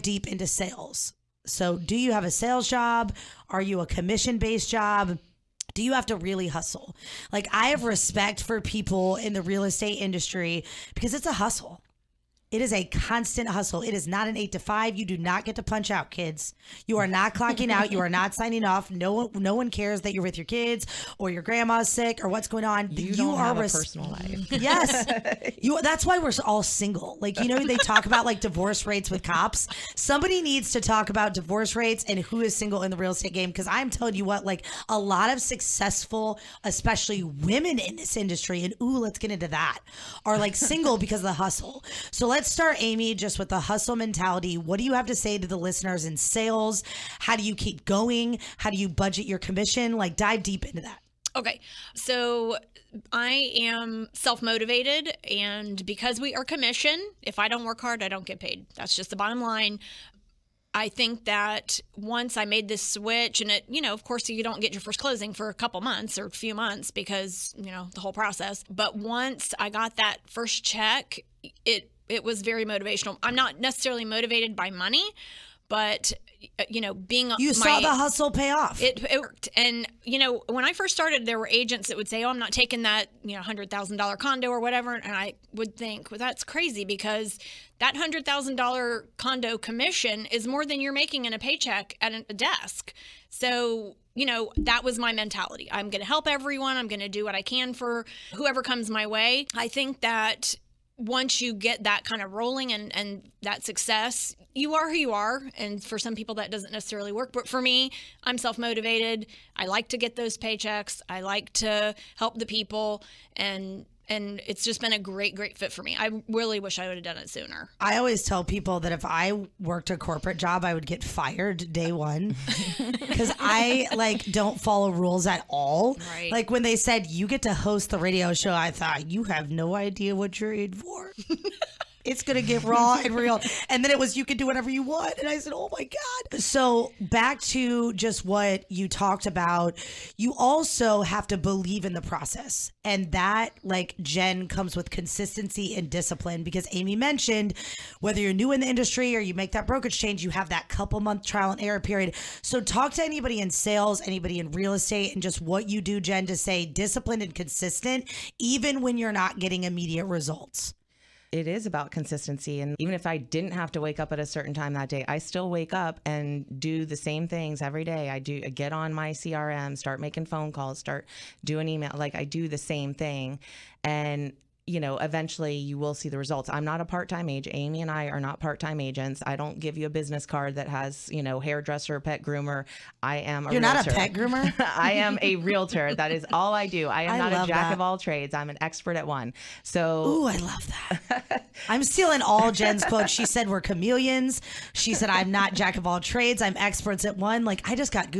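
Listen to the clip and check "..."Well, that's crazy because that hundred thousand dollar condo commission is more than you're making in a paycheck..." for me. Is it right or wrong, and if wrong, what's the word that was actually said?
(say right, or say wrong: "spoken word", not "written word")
right.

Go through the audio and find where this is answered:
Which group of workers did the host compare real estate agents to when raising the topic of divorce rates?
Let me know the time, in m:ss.
0:29.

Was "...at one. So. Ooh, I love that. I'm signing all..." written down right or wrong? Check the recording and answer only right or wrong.
wrong.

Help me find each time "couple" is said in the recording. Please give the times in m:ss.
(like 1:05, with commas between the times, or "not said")
1:05, 2:30.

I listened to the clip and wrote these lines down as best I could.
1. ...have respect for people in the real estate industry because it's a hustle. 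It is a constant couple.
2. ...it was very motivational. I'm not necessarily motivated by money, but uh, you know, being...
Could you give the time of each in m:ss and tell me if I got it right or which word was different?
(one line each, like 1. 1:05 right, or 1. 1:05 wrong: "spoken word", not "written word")
1. 0:07 wrong: "hustle", not "couple"
2. 1:12 right.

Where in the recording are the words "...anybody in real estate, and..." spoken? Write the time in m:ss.
2:34.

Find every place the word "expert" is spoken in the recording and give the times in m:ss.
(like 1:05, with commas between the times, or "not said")
3:08, 3:16.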